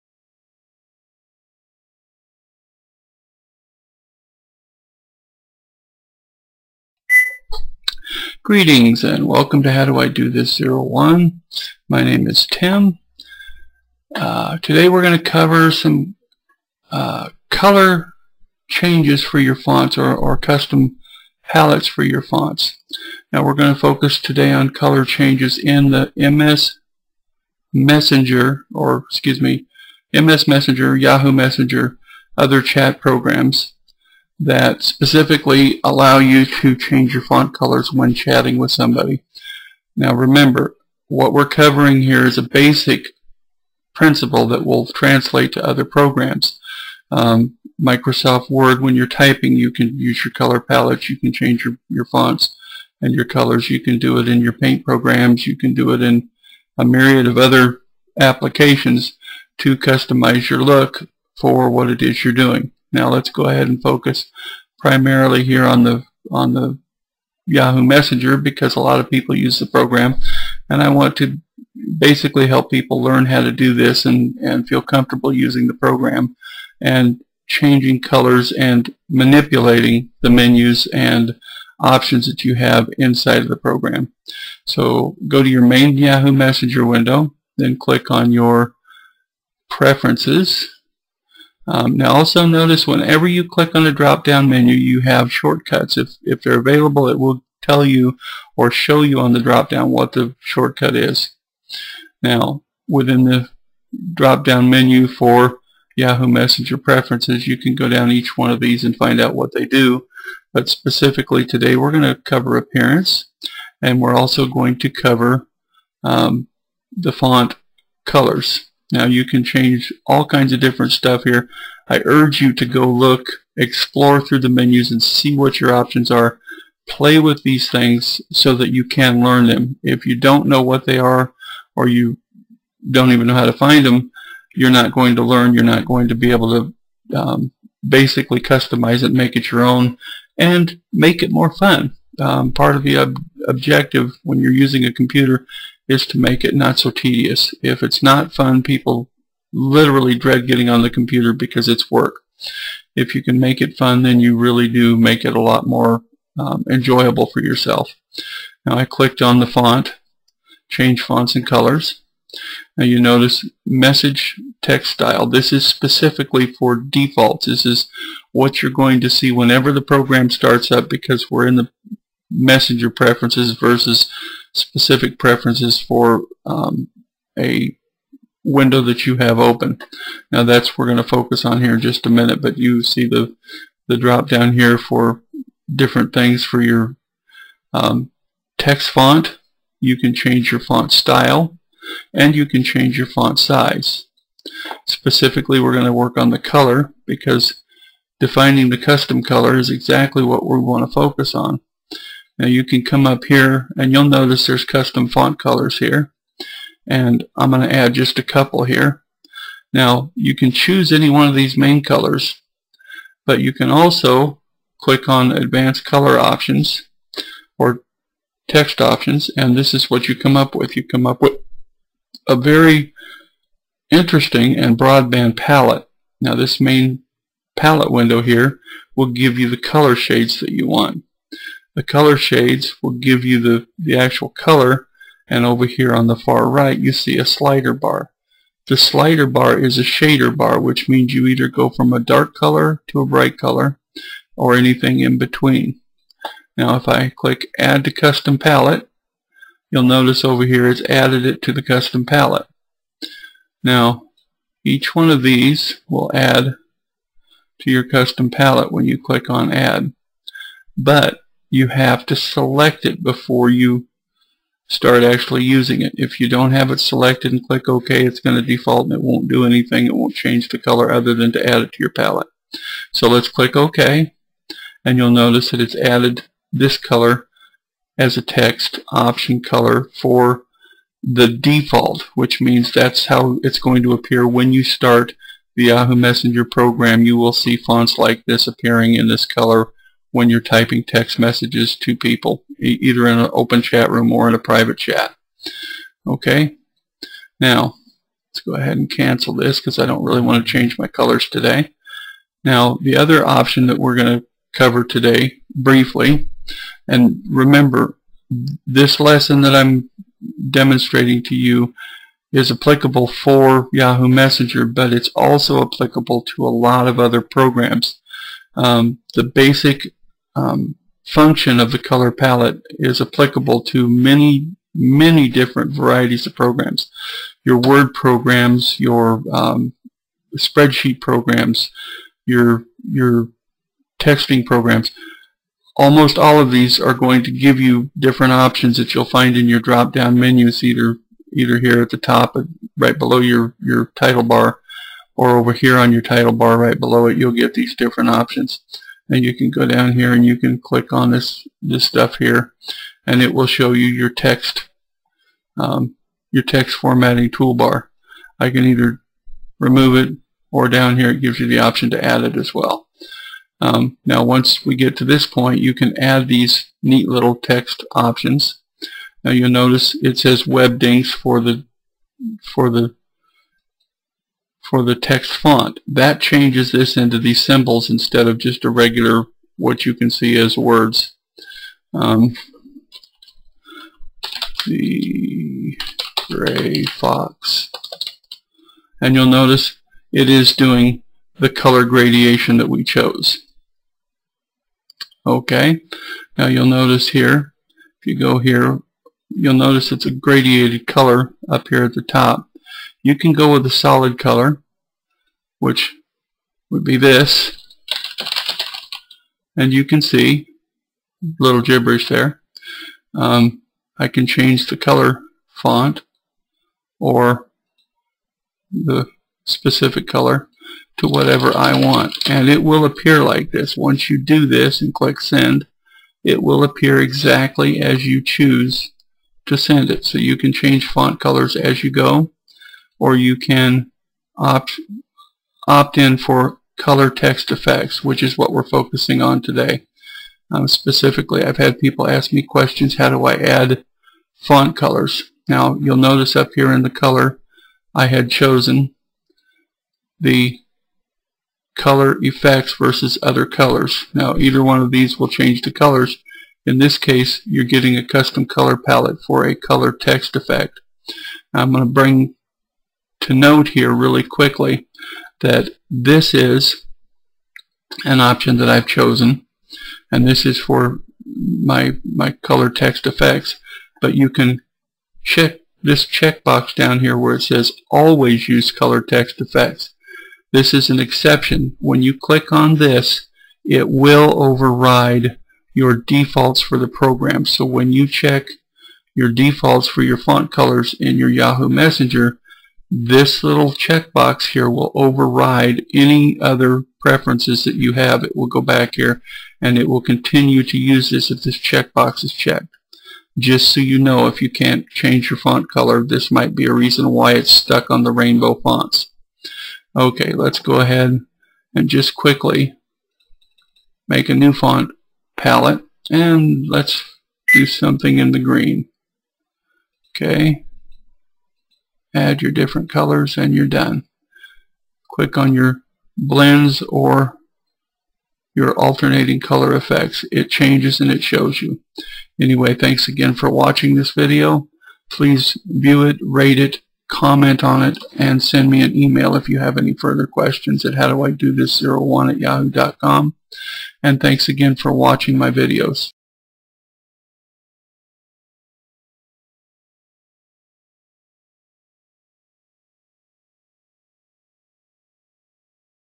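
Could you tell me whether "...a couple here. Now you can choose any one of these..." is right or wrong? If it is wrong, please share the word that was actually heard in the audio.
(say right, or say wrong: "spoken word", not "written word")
right.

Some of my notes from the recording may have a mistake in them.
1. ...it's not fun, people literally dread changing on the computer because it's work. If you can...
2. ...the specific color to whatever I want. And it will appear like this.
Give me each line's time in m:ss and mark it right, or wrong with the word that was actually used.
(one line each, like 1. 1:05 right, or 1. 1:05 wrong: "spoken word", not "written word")
1. 2:27 wrong: "getting", not "changing"
2. 6:58 right.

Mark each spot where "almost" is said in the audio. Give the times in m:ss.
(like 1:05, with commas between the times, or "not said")
5:35.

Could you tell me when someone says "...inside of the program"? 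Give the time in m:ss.
1:22.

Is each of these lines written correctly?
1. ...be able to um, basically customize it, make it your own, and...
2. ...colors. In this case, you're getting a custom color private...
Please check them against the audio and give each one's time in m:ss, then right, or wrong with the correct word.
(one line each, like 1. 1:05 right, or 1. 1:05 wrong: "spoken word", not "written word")
1. 2:16 right
2. 7:35 wrong: "palette", not "private".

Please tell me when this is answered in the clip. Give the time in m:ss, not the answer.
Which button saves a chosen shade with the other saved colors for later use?
4:07.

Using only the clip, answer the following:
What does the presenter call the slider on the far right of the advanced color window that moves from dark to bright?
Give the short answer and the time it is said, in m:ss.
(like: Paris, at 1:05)
shader bar, at 3:59.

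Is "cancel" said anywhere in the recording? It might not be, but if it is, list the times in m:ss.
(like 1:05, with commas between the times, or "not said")
4:58.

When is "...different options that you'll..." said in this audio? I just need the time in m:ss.
5:37.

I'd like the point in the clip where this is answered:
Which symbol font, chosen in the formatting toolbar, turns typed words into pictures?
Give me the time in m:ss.
6:10.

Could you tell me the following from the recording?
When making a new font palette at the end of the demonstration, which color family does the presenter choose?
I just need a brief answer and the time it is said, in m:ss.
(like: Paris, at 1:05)
green, at 8:38.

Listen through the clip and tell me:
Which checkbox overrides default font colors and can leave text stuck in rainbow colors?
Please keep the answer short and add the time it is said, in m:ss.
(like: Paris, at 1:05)
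always use color text effects, at 7:57.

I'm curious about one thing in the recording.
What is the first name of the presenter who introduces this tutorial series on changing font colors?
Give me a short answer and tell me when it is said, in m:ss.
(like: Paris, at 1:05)
Tim, at 0:12.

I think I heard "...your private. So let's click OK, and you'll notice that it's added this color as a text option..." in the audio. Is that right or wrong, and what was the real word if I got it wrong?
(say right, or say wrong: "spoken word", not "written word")
wrong: "palette", not "private".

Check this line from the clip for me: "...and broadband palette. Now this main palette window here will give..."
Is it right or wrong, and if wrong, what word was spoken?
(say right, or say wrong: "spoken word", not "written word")
right.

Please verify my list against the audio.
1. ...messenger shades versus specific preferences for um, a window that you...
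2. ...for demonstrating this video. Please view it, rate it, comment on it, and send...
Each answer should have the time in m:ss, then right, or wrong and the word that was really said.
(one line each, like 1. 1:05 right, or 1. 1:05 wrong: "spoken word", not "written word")
1. 2:52 wrong: "preferences", not "shades"
2. 8:53 wrong: "watching", not "demonstrating".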